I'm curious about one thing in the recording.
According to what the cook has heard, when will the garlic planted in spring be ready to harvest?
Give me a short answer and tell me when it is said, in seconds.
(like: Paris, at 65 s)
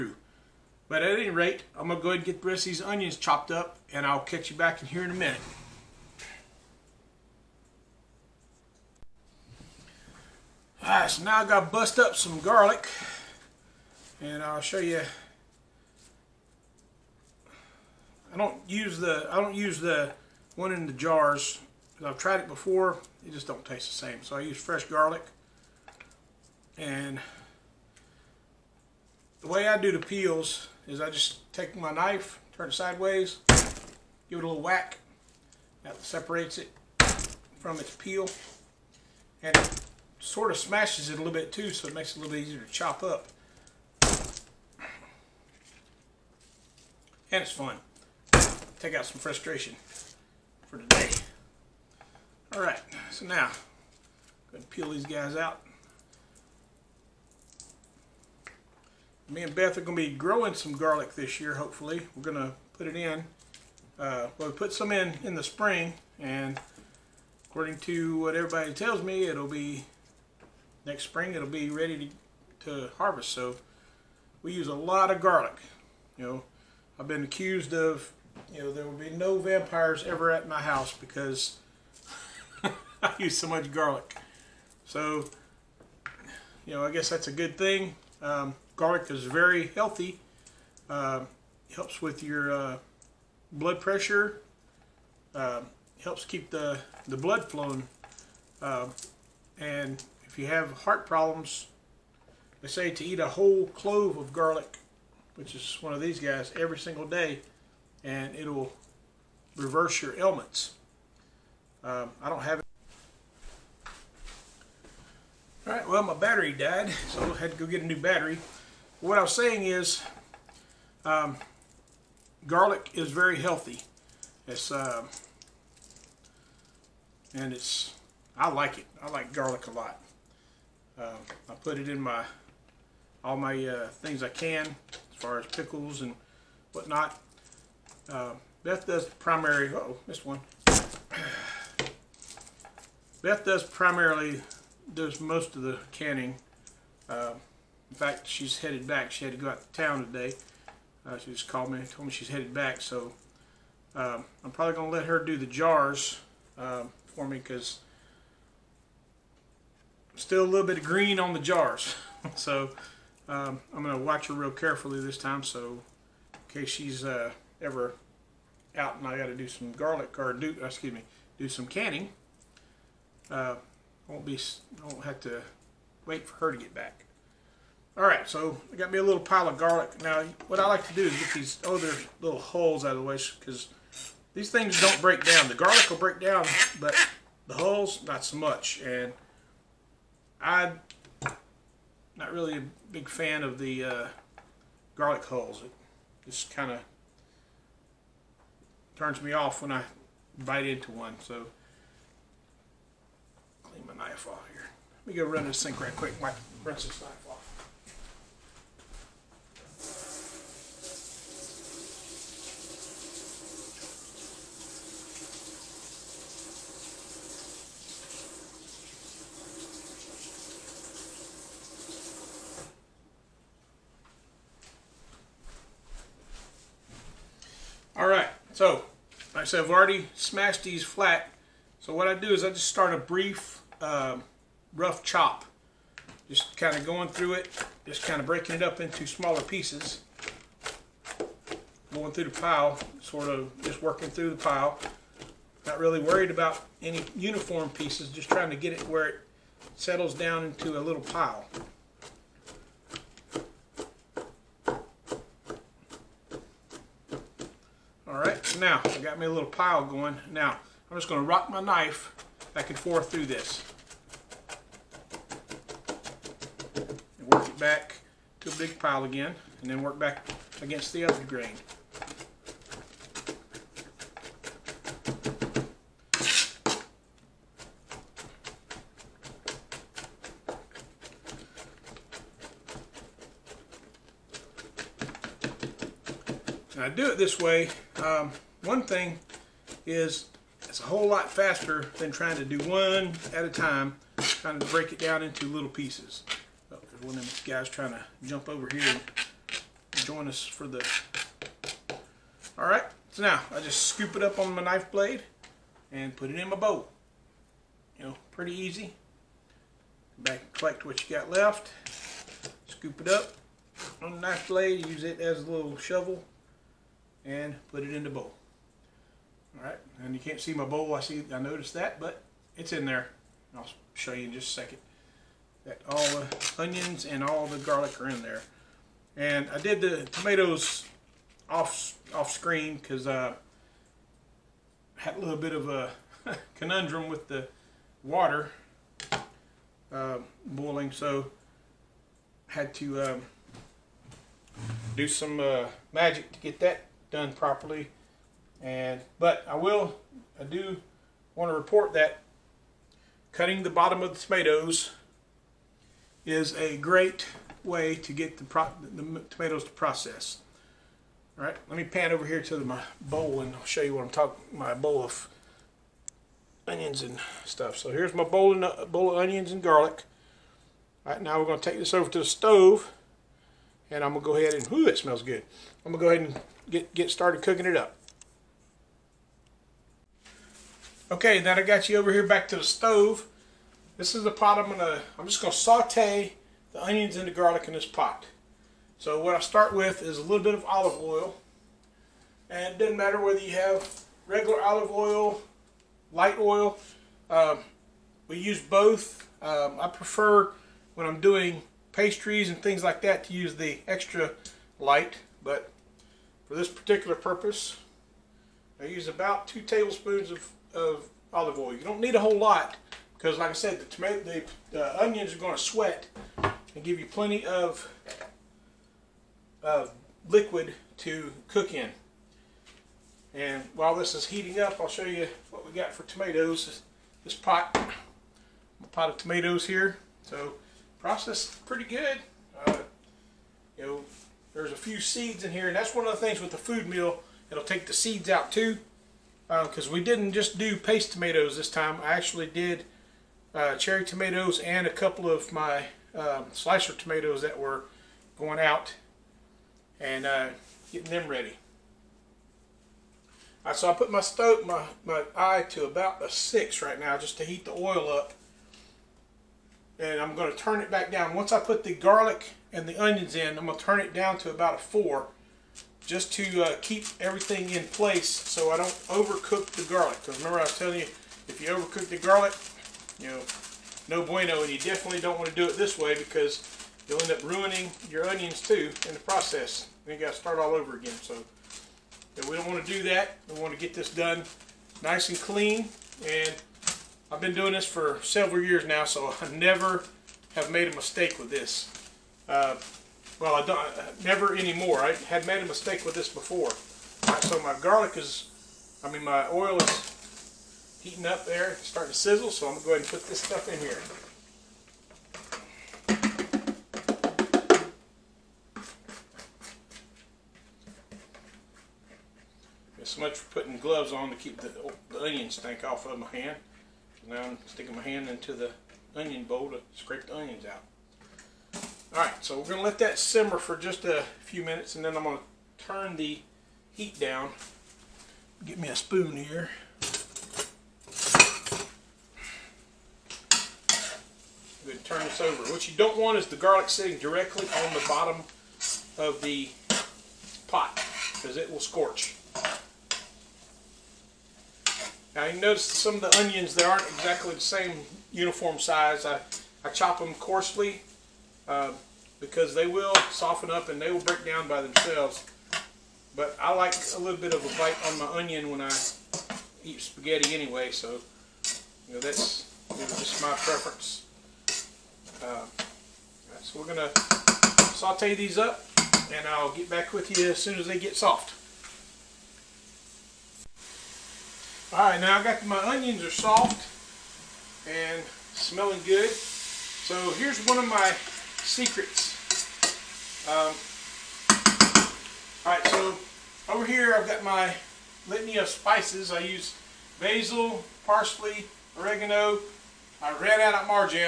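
Next spring, at 70 s.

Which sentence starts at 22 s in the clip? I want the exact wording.
I've tried it before, it just don't taste the same.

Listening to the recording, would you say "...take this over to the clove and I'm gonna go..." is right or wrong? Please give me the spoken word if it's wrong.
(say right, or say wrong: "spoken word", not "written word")
wrong: "stove", not "clove".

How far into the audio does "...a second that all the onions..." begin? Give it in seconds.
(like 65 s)
324 s.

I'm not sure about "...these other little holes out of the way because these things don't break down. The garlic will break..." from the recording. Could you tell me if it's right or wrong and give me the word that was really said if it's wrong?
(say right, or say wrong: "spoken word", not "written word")
right.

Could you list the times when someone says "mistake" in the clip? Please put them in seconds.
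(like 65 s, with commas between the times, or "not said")
490 s, 495 s.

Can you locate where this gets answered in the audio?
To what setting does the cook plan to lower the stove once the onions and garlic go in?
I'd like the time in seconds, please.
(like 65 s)
464 s.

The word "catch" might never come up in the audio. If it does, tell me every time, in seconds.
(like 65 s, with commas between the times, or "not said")
4 s.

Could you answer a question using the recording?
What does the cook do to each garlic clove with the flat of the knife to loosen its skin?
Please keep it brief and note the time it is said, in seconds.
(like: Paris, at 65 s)
Give it a little whack, at 33 s.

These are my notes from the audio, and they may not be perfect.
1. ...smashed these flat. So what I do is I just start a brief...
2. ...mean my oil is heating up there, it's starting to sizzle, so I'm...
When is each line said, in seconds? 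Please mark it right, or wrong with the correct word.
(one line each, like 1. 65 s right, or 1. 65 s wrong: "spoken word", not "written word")
1. 230 s right
2. 499 s right.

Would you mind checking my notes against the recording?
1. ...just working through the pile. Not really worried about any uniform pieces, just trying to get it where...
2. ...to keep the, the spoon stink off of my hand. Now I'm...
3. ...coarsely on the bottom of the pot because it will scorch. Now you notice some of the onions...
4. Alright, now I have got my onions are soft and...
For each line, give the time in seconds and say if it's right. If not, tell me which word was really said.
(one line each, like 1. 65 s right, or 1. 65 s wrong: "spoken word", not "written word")
1. 243 s right
2. 514 s wrong: "onion", not "spoon"
3. 537 s wrong: "directly", not "coarsely"
4. 574 s right.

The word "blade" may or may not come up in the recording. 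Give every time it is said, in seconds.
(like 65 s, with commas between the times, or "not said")
304 s, 314 s.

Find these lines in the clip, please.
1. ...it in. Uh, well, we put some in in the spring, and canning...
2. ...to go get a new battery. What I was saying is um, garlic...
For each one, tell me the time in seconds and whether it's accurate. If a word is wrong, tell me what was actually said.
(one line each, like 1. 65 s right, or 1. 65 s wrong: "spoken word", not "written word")
1. 62 s wrong: "according", not "canning"
2. 117 s right.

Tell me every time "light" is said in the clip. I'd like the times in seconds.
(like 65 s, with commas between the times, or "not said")
396 s, 404 s.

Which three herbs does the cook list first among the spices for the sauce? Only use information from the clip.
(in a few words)
Basil, parsley, oregano.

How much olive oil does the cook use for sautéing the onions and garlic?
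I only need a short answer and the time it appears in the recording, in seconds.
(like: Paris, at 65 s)
2 tablespoons, at 409 s.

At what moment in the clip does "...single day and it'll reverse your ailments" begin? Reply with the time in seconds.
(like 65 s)
106 s.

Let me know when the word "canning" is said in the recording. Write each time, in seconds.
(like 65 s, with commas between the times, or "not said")
145 s, 171 s.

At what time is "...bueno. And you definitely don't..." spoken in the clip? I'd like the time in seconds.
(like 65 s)
474 s.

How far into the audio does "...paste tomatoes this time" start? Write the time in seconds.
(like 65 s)
440 s.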